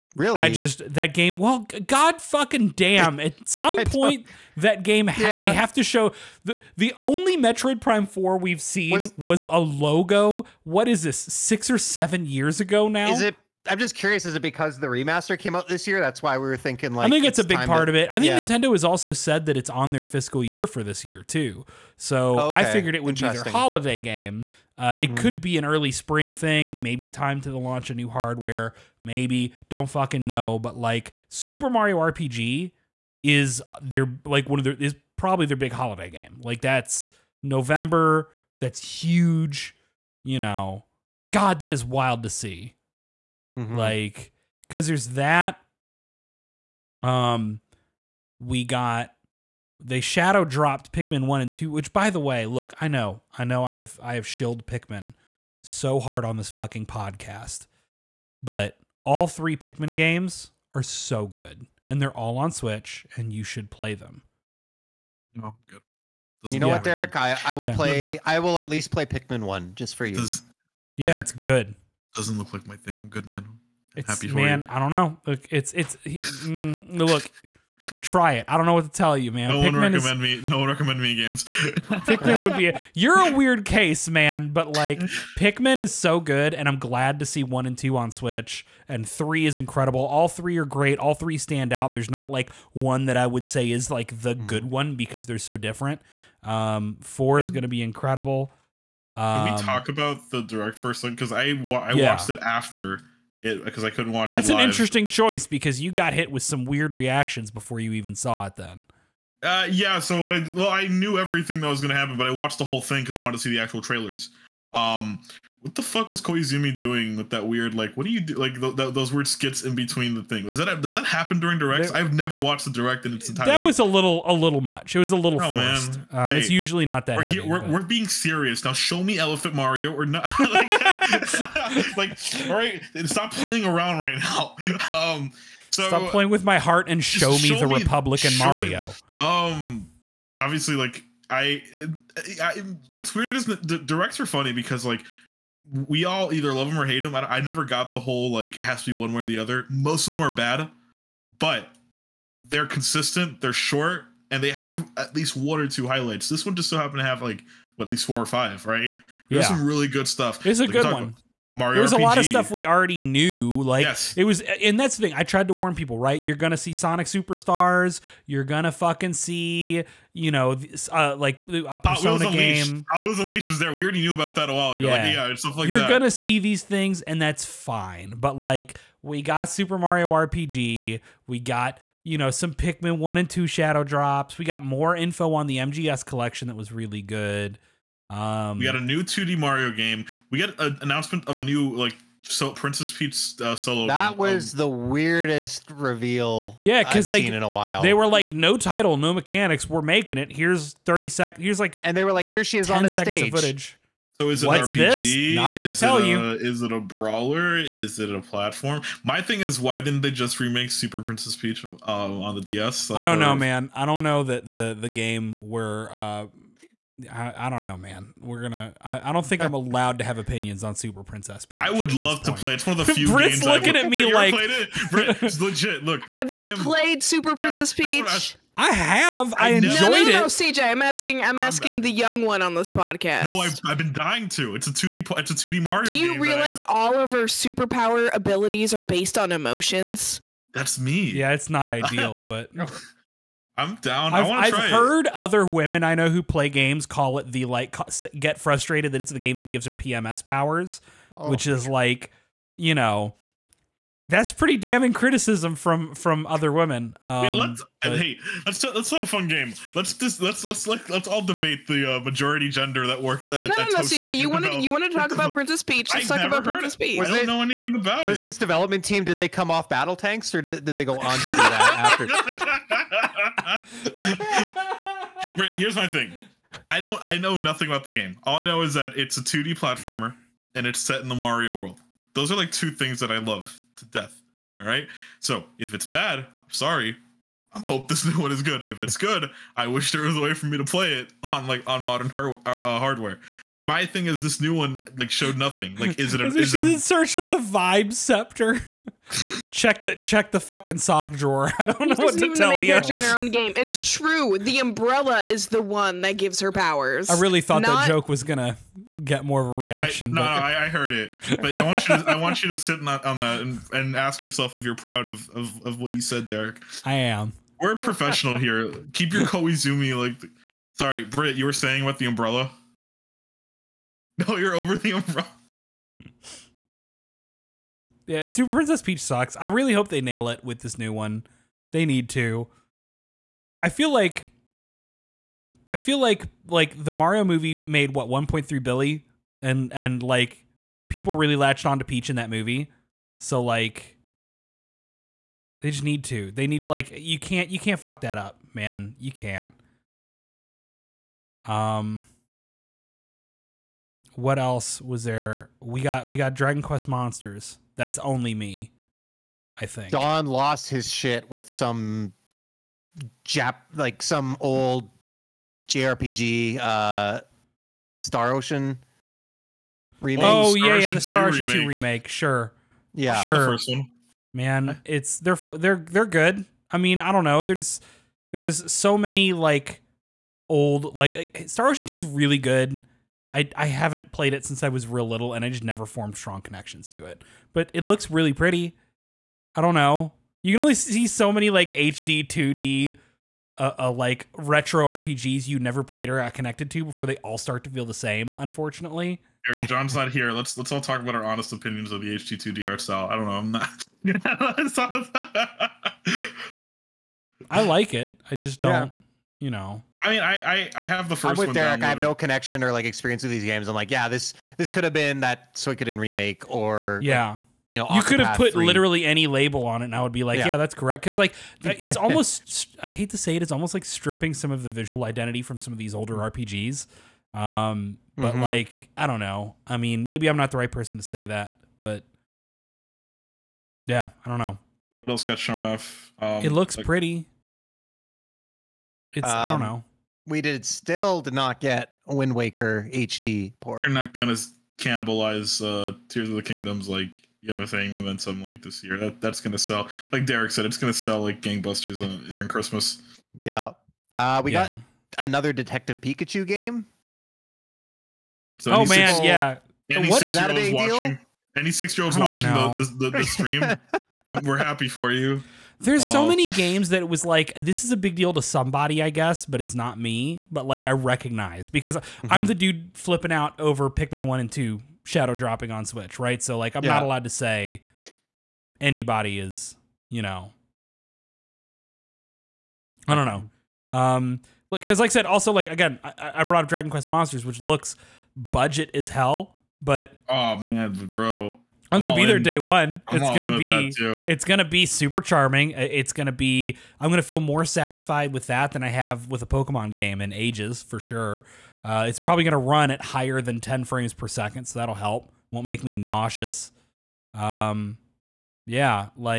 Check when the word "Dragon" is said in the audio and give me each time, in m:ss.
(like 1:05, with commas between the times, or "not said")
5:56, 8:06.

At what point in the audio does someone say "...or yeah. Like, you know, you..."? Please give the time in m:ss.
6:56.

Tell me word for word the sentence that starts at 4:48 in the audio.
If it's good, I wish there was a way for me to play it on like on modern uh, uh, hardware.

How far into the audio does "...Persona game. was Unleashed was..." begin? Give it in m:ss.
2:51.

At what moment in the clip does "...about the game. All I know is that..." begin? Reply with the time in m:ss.
4:37.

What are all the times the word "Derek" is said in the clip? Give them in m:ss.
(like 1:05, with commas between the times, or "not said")
1:06, 1:11, 5:16, 6:51, 7:30.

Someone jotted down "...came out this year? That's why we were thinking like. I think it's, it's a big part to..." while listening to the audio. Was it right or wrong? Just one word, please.
right.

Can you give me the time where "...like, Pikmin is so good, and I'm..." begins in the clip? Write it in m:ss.
1:24.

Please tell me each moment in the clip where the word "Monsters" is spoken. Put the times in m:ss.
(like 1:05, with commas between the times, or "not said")
5:56, 8:07.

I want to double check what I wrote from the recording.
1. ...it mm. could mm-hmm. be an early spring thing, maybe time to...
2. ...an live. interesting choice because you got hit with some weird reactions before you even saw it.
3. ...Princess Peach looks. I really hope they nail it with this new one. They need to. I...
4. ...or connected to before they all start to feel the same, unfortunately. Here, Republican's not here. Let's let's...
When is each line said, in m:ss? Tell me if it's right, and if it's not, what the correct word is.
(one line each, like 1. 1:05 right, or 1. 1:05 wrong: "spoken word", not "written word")
1. 0:24 right
2. 1:44 right
3. 5:28 wrong: "sucks", not "looks"
4. 6:36 wrong: "John", not "Republican".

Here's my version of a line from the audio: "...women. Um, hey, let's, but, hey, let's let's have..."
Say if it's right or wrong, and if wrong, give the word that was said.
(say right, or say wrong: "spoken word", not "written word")
right.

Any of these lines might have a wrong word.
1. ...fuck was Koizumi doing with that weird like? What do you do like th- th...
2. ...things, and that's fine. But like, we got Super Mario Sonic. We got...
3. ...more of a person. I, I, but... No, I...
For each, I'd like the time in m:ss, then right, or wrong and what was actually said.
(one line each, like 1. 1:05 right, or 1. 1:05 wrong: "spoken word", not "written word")
1. 1:55 right
2. 2:56 wrong: "RPG", not "Sonic"
3. 5:09 wrong: "reaction", not "person".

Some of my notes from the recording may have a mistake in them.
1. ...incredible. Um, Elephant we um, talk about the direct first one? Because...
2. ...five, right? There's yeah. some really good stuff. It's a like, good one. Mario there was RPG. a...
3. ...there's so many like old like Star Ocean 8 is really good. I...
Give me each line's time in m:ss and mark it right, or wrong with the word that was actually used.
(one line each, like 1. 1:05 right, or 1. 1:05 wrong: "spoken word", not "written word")
1. 1:37 wrong: "Can", not "Elephant"
2. 2:38 right
3. 6:18 wrong: "2", not "8".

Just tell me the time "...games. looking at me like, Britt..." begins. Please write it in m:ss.
3:43.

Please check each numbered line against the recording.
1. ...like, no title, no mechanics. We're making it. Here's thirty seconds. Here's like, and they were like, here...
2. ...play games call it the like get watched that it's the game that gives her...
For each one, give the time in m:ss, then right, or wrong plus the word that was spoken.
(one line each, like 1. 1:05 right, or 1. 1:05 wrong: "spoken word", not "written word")
1. 3:18 right
2. 4:06 wrong: "frustrated", not "watched".